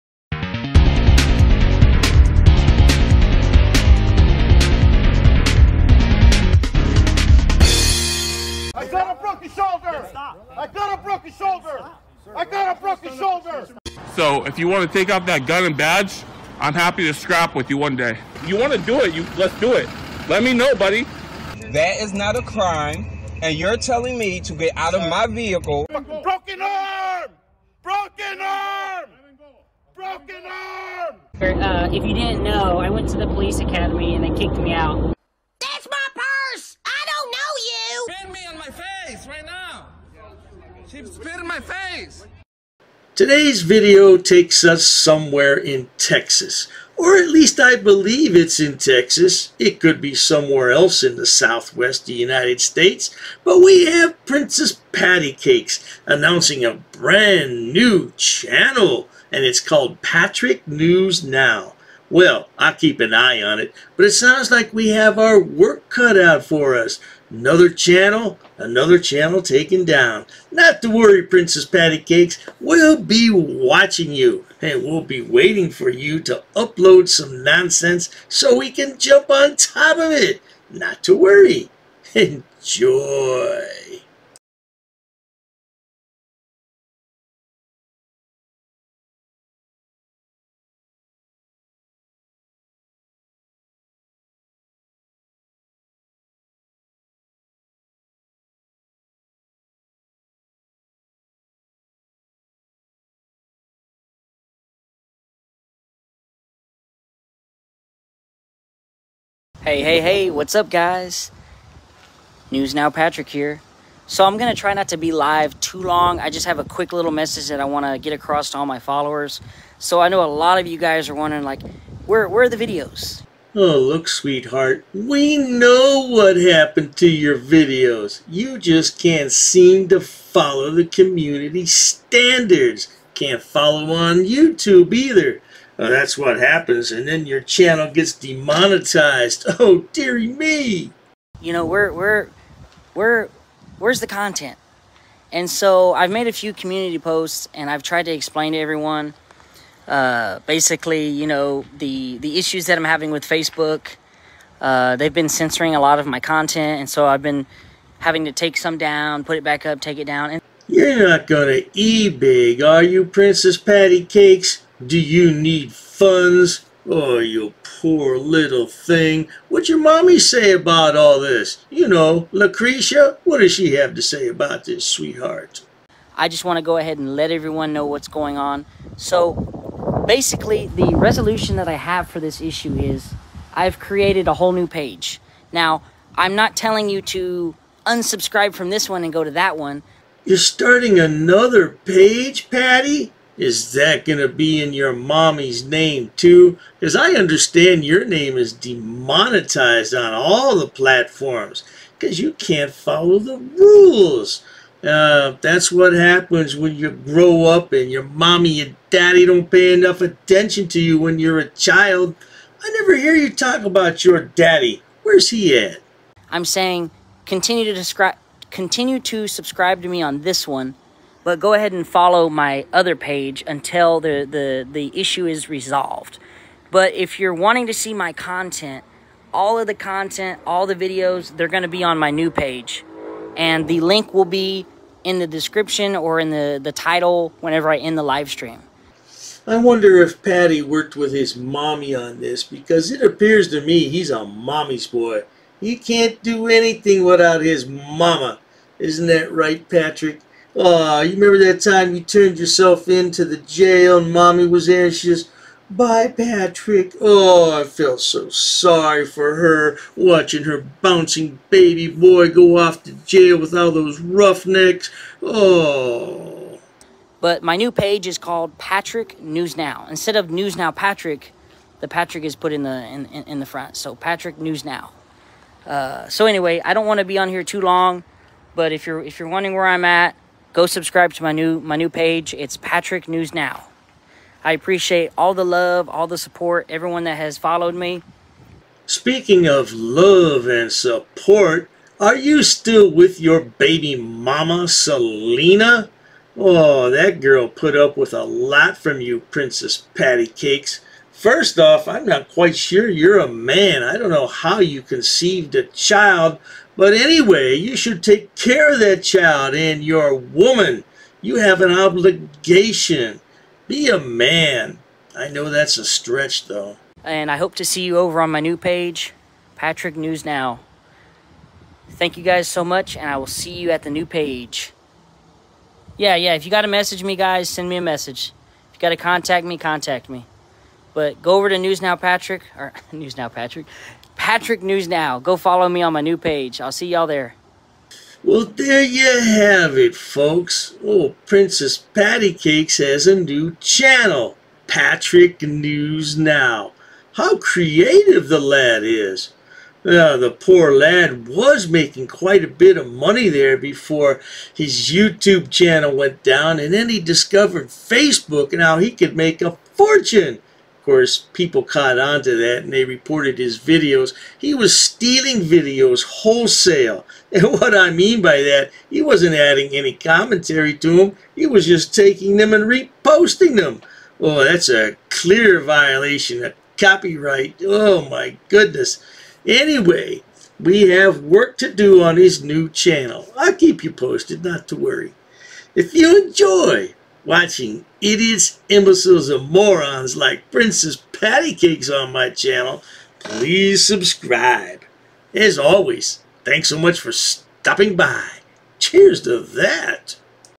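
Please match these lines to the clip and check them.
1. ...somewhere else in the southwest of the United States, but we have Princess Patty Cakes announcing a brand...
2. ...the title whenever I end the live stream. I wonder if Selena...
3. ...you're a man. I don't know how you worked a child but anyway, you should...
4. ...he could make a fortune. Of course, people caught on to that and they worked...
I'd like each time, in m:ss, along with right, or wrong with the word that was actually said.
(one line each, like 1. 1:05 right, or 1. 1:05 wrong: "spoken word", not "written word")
1. 0:50 right
2. 3:56 wrong: "Patty", not "Selena"
3. 5:02 wrong: "conceived", not "worked"
4. 5:58 wrong: "reported", not "worked".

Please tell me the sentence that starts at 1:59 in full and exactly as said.
So, I know a lot of you guys are wondering, like, where, where are the videos?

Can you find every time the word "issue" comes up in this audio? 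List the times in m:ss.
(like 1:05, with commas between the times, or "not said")
2:32, 3:02, 3:44.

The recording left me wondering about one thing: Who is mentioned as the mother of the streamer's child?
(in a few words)
Selena.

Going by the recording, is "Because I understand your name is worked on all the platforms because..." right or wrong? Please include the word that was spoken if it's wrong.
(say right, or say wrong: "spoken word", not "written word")
wrong: "demonetized", not "worked".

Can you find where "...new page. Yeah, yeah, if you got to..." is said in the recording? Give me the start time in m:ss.
5:23.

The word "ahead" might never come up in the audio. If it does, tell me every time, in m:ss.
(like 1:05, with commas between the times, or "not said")
2:56, 3:41.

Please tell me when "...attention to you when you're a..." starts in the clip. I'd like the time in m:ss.
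3:30.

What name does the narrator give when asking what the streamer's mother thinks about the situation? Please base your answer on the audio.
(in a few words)
Lucretia.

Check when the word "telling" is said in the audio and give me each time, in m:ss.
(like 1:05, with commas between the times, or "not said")
0:23, 3:06.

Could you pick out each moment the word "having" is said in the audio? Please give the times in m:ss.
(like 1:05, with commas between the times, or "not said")
2:32, 2:37.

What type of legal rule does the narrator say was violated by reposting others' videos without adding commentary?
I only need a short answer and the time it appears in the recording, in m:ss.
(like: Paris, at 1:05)
Copyright, at 6:16.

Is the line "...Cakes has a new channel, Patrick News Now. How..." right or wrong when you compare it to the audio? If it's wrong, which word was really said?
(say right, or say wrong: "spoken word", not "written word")
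right.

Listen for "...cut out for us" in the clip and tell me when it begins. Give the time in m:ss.
1:05.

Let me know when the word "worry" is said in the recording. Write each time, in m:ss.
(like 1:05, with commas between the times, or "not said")
1:10, 1:21, 6:24.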